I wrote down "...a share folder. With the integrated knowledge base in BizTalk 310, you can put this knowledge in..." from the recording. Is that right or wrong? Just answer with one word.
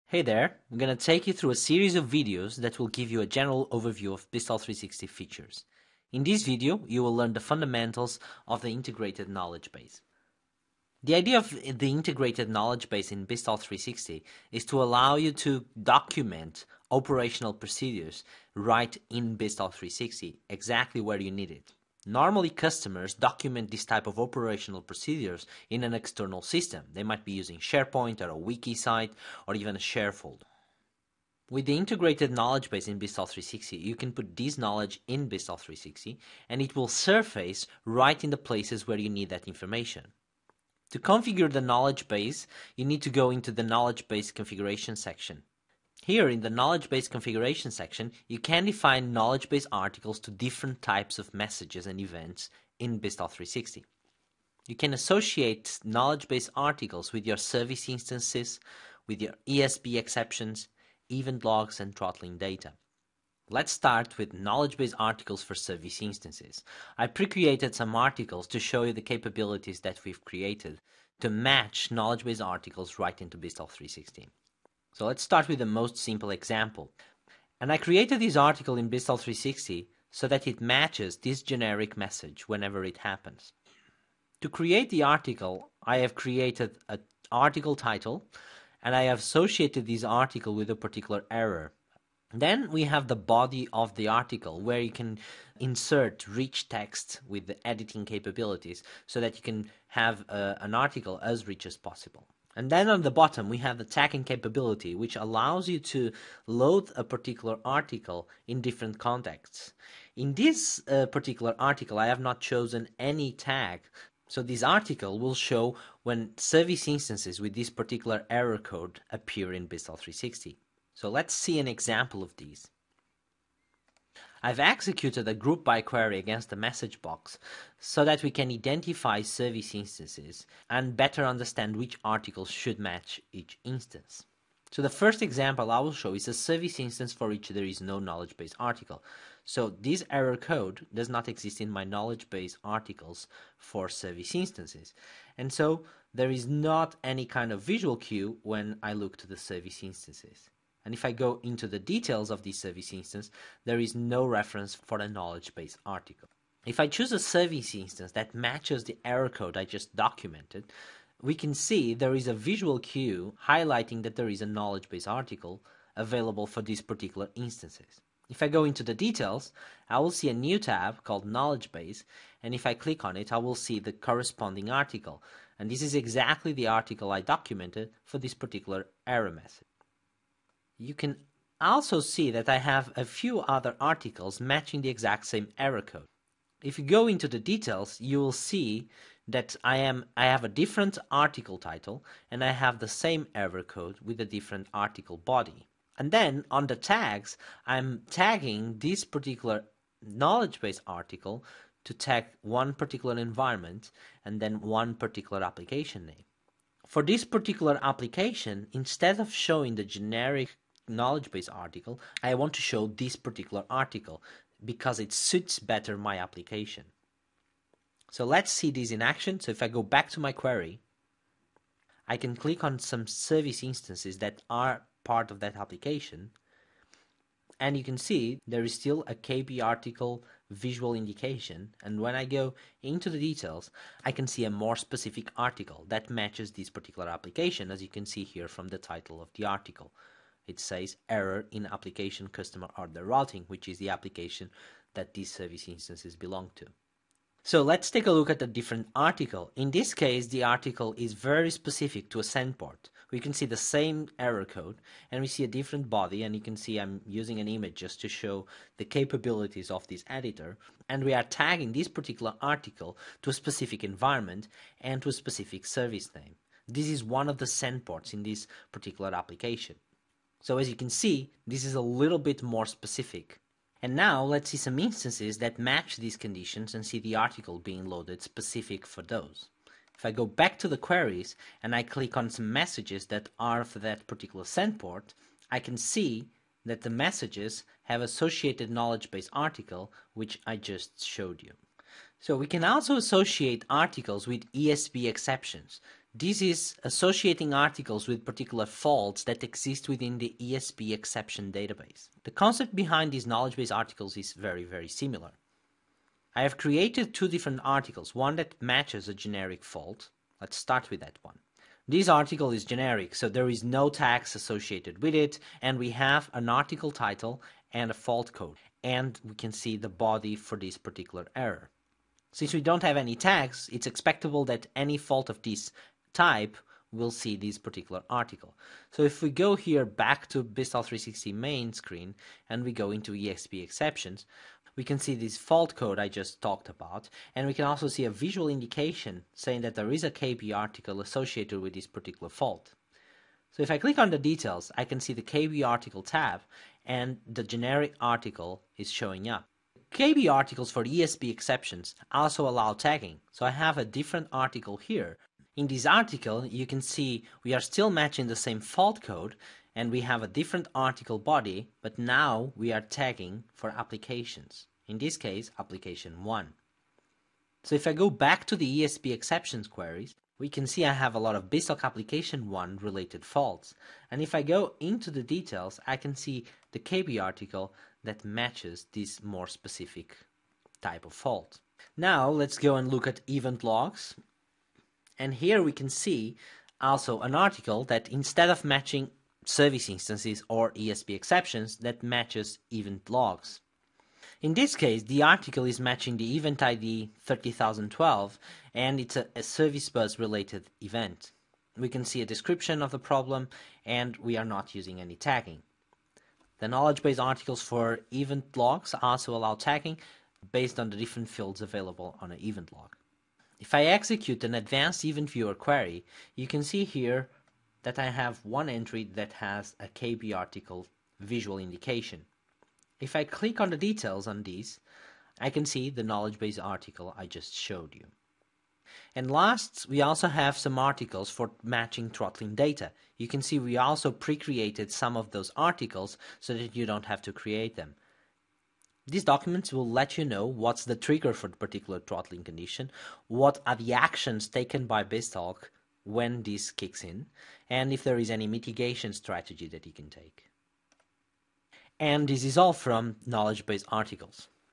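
wrong.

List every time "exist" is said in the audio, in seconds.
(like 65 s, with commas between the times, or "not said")
141 s, 299 s.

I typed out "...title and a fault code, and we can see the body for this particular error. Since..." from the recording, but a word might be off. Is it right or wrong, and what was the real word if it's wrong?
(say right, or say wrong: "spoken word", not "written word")
right.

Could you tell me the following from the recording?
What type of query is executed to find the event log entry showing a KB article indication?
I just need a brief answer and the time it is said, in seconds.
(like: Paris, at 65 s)
advanced event viewer query, at 414 s.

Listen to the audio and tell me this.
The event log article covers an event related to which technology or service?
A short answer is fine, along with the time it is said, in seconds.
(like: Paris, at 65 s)
service bus, at 399 s.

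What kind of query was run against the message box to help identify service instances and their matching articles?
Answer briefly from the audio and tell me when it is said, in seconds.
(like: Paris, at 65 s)
group by query, at 125 s.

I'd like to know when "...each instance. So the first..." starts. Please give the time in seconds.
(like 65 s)
133 s.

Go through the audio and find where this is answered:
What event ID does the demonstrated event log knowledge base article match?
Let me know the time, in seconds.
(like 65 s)
397 s.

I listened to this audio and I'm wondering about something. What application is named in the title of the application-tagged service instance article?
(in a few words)
customer order routing.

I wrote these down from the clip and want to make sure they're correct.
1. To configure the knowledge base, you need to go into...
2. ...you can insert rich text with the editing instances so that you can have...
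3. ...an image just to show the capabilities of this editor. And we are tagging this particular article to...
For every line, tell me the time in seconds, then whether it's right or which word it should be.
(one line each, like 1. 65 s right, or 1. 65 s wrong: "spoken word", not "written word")
1. 40 s right
2. 94 s wrong: "capabilities", not "instances"
3. 257 s right.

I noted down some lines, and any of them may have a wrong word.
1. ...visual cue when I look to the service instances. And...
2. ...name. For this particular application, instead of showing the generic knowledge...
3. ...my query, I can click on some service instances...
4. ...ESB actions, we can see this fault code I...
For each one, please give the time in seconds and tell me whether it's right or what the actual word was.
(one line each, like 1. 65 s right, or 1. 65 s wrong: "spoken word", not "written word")
1. 147 s right
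2. 206 s right
3. 220 s right
4. 333 s wrong: "exceptions", not "actions".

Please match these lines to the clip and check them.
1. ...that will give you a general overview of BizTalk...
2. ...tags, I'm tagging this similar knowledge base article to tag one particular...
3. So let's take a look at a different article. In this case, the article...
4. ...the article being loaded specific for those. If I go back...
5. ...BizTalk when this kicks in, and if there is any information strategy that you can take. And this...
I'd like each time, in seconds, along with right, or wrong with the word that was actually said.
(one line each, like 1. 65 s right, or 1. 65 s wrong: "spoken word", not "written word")
1. 2 s right
2. 196 s wrong: "particular", not "similar"
3. 247 s right
4. 276 s right
5. 445 s wrong: "mitigation", not "information".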